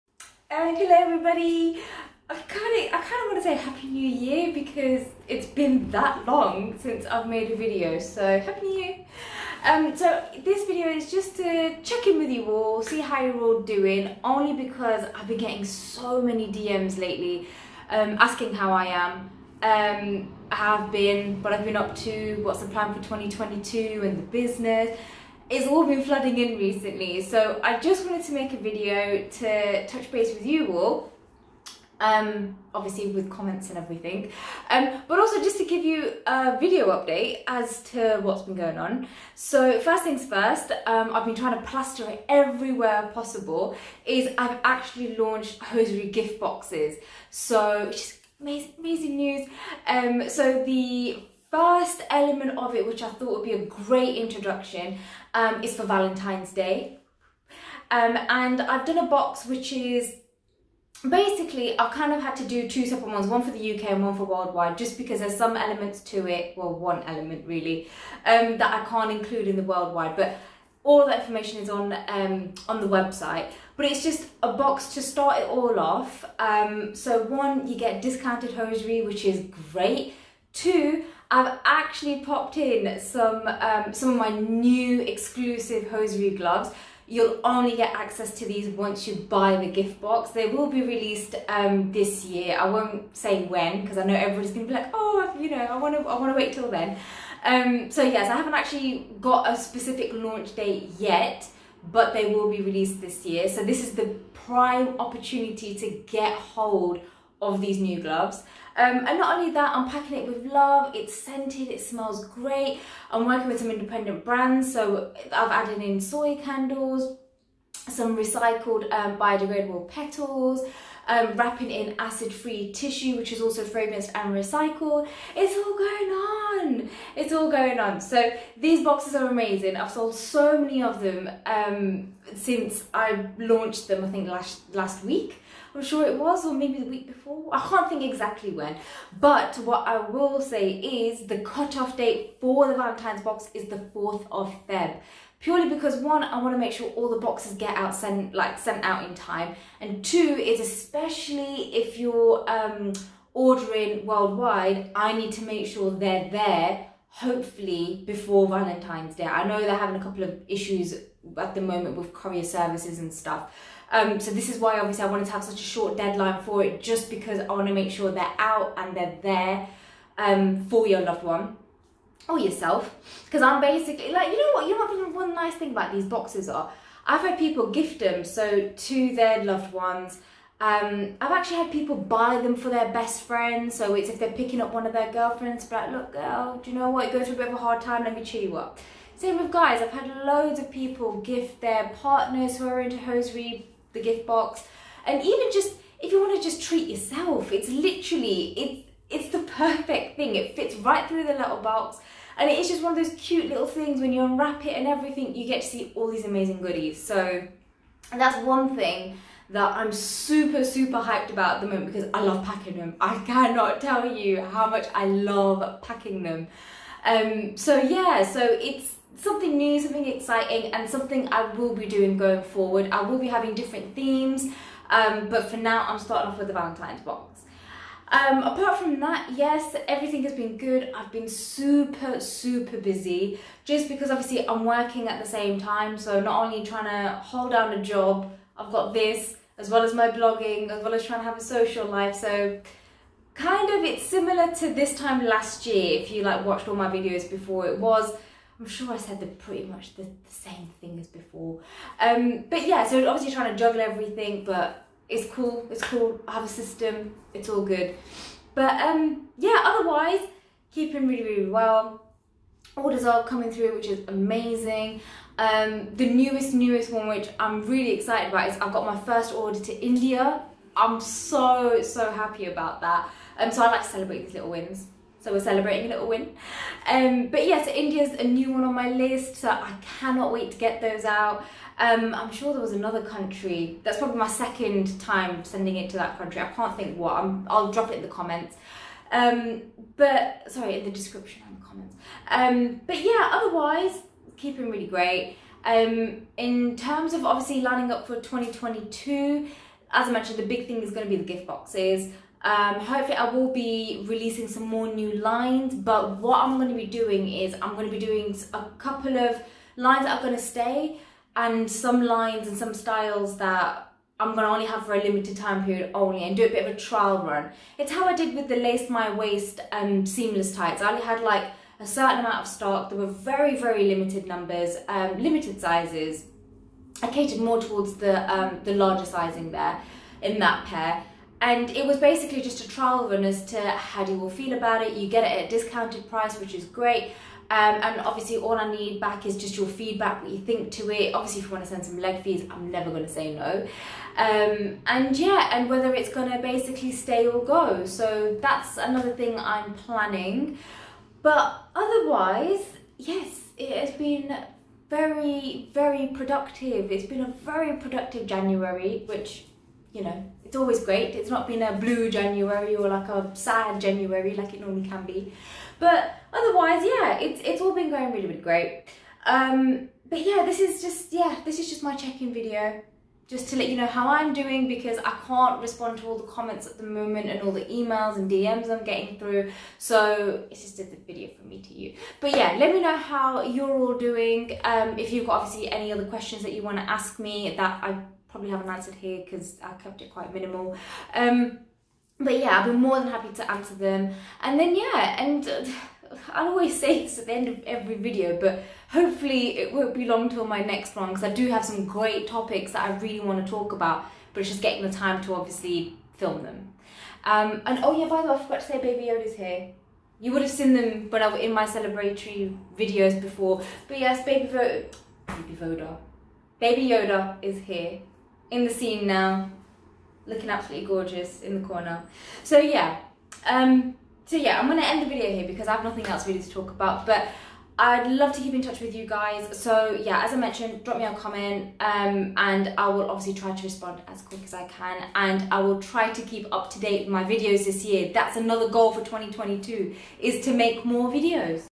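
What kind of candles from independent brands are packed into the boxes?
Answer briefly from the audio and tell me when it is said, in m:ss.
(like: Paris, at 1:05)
soy candles, at 1:55.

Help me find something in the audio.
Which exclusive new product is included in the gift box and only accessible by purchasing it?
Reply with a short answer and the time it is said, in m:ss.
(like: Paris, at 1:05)
hosiery gloves, at 1:25.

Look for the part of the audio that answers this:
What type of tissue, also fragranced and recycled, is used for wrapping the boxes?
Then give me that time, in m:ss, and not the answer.
2:01.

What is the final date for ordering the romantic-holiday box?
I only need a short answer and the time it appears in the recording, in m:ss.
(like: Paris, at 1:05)
4th of Feb, at 2:23.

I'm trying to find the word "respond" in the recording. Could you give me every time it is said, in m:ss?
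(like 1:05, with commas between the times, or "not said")
6:15, 7:13.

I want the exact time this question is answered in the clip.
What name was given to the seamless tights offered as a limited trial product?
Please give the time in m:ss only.
5:18.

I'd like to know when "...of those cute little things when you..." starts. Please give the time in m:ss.
3:22.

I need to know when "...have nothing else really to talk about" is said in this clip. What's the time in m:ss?
7:05.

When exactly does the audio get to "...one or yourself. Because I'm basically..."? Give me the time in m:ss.
2:51.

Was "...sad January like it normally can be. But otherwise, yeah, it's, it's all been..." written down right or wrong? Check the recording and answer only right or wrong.
right.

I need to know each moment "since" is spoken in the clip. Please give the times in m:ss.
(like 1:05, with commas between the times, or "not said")
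0:06, 2:12.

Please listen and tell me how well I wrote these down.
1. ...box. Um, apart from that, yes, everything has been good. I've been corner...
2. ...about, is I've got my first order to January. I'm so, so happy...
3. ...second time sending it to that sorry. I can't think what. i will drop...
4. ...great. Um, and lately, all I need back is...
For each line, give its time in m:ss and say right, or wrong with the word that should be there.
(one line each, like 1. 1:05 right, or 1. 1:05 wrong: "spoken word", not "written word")
1. 3:47 wrong: "super", not "corner"
2. 4:28 wrong: "India", not "January"
3. 4:44 wrong: "country", not "sorry"
4. 5:36 wrong: "obviously", not "lately".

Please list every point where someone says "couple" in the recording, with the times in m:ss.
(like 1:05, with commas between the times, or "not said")
2:40, 5:08.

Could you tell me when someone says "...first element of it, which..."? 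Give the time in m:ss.
0:51.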